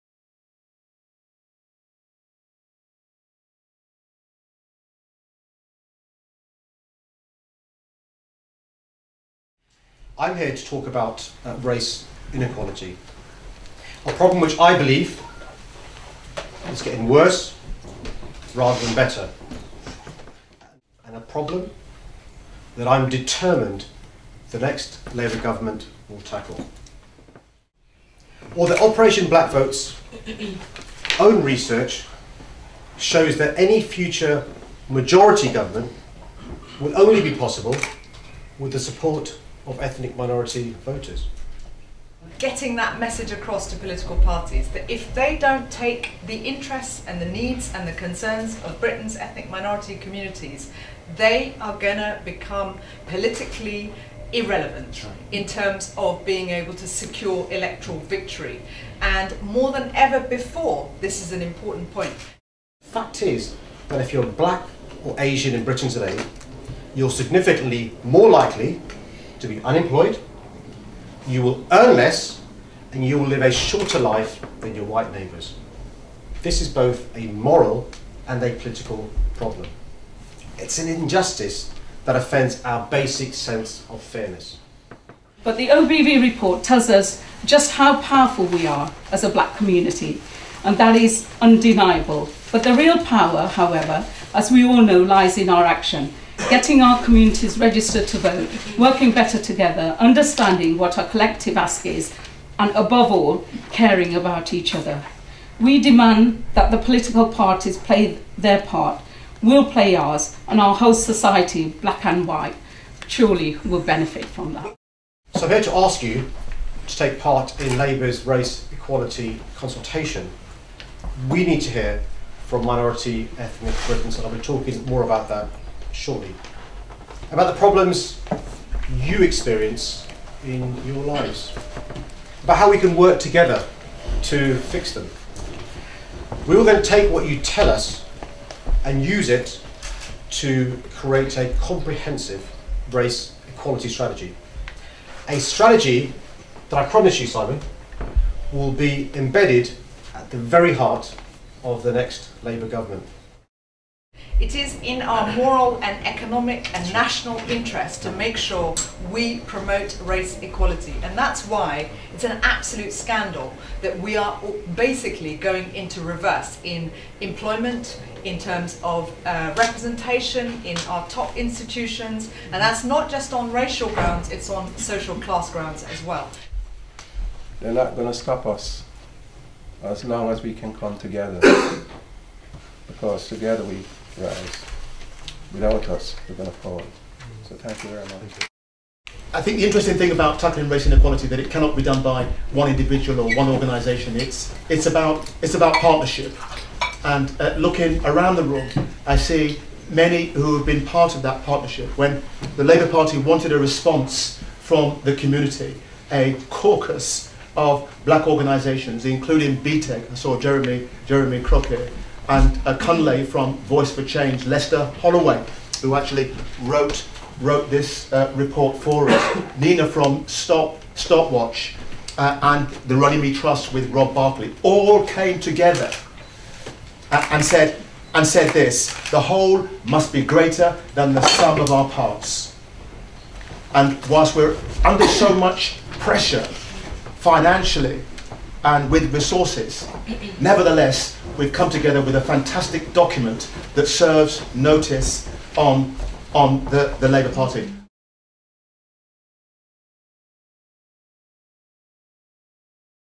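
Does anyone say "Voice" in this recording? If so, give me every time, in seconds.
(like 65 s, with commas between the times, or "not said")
213 s.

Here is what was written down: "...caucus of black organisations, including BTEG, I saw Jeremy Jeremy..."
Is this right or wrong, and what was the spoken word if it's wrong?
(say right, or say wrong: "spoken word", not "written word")
right.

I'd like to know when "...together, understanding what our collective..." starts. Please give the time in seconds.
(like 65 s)
99 s.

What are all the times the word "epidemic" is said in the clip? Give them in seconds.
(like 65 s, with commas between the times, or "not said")
not said.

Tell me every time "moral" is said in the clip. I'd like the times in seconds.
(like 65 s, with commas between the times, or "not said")
77 s, 155 s.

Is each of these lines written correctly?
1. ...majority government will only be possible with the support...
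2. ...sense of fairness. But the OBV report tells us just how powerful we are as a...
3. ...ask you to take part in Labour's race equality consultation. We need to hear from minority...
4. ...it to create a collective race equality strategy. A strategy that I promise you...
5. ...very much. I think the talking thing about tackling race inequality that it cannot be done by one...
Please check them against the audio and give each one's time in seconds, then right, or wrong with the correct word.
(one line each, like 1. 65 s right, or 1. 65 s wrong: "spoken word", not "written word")
1. 34 s right
2. 83 s right
3. 115 s right
4. 139 s wrong: "comprehensive", not "collective"
5. 187 s wrong: "interesting", not "talking".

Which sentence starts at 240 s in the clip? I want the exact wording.
Nevertheless, we've come together with a fantastic document that serves notice on, on the, the Labour Party.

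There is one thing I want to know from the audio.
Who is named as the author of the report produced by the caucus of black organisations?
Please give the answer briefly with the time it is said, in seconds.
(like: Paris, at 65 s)
Lester Holloway, at 214 s.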